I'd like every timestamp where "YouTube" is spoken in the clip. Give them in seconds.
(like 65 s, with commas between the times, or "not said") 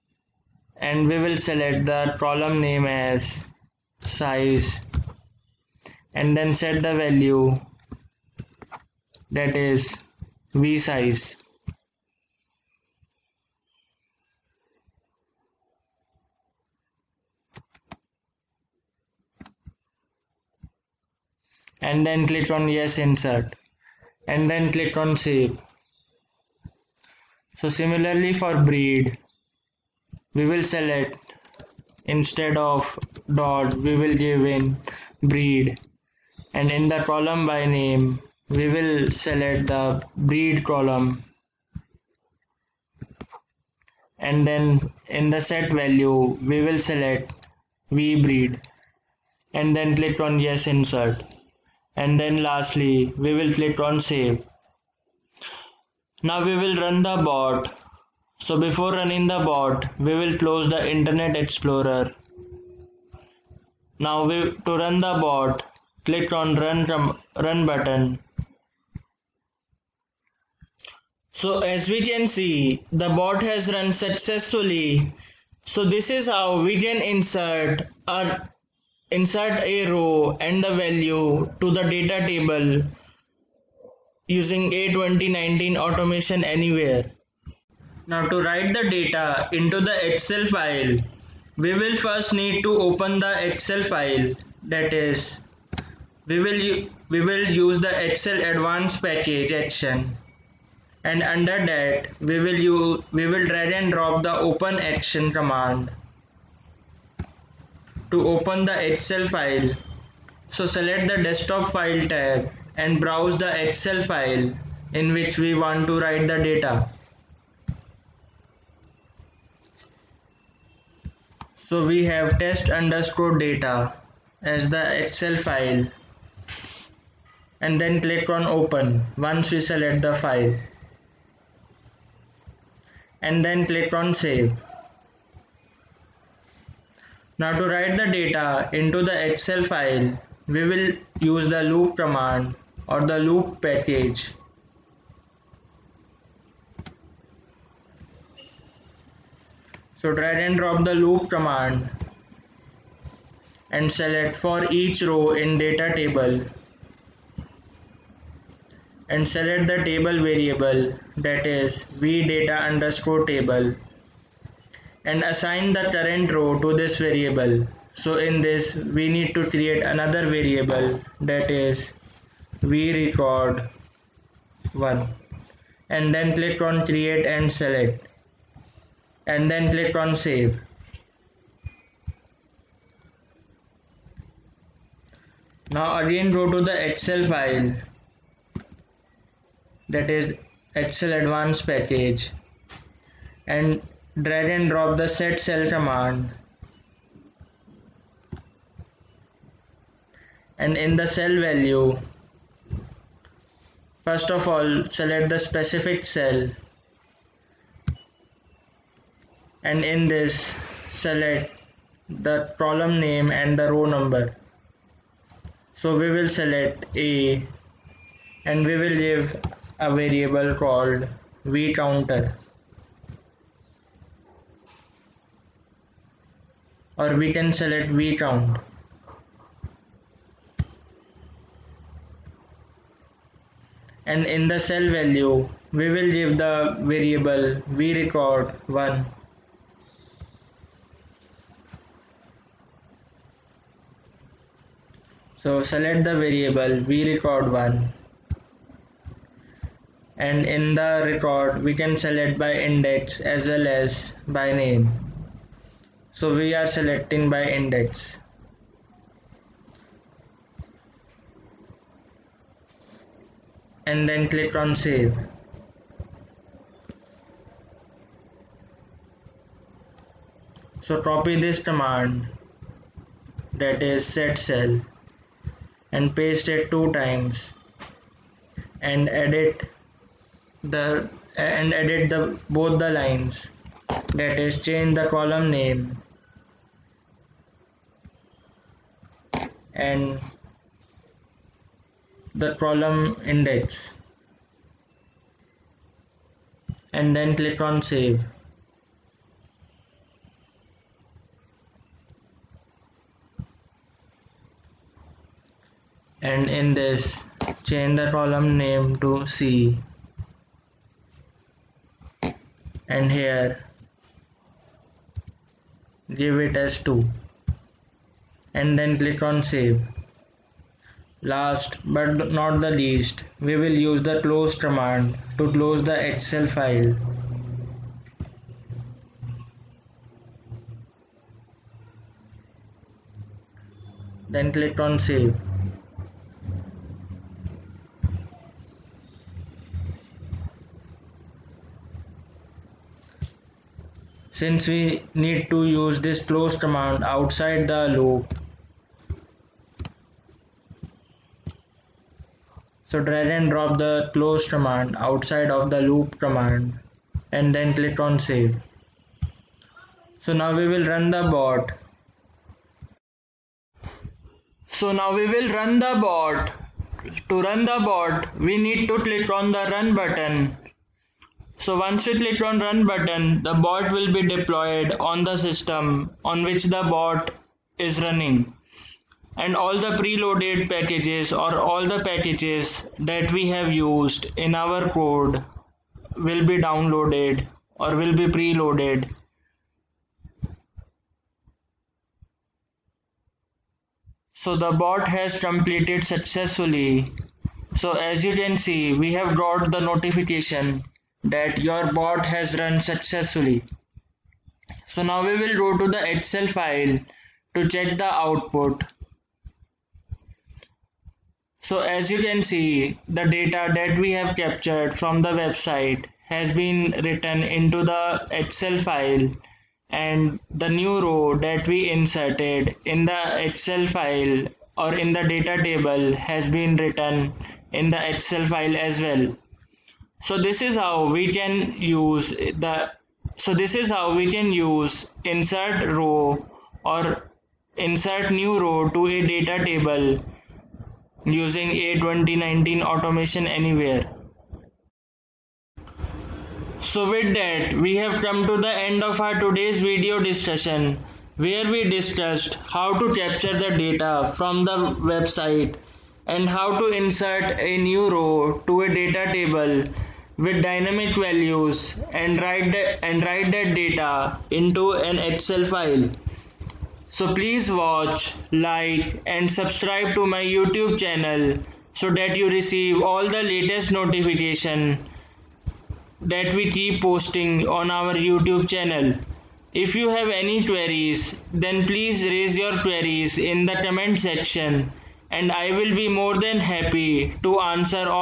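470 s, 478 s.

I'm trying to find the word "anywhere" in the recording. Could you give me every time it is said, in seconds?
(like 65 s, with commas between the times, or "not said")
86 s, 443 s.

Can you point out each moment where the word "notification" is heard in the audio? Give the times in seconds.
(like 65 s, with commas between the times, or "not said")
399 s, 473 s.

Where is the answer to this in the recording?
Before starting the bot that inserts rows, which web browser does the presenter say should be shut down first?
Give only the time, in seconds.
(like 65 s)
60 s.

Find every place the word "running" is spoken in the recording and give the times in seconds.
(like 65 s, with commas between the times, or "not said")
58 s, 378 s.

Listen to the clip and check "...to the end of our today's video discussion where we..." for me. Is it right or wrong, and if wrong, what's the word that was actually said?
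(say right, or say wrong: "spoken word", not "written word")
right.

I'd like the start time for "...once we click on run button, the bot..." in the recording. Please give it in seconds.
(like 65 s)
371 s.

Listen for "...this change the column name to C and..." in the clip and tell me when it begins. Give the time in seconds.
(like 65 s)
306 s.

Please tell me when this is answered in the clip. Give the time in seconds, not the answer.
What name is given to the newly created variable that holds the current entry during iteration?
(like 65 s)
172 s.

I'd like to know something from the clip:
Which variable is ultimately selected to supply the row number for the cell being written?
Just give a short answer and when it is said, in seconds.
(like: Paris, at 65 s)
vCount, at 227 s.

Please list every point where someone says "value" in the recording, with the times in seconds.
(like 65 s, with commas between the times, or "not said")
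6 s, 45 s, 80 s, 201 s, 234 s, 461 s.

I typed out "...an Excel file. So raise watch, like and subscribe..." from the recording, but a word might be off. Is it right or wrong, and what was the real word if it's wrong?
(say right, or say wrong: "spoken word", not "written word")
wrong: "please", not "raise".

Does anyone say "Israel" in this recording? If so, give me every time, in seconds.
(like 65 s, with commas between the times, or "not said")
not said.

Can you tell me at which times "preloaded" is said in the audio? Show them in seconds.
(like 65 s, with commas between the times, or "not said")
379 s, 388 s.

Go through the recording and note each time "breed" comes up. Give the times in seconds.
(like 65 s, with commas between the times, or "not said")
28 s, 35 s, 40 s, 48 s.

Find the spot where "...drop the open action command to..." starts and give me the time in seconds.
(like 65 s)
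103 s.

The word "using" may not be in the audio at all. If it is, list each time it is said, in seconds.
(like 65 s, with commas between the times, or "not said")
84 s, 441 s.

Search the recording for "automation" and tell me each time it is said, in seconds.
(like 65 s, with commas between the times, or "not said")
85 s, 442 s.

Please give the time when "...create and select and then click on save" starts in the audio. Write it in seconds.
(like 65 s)
176 s.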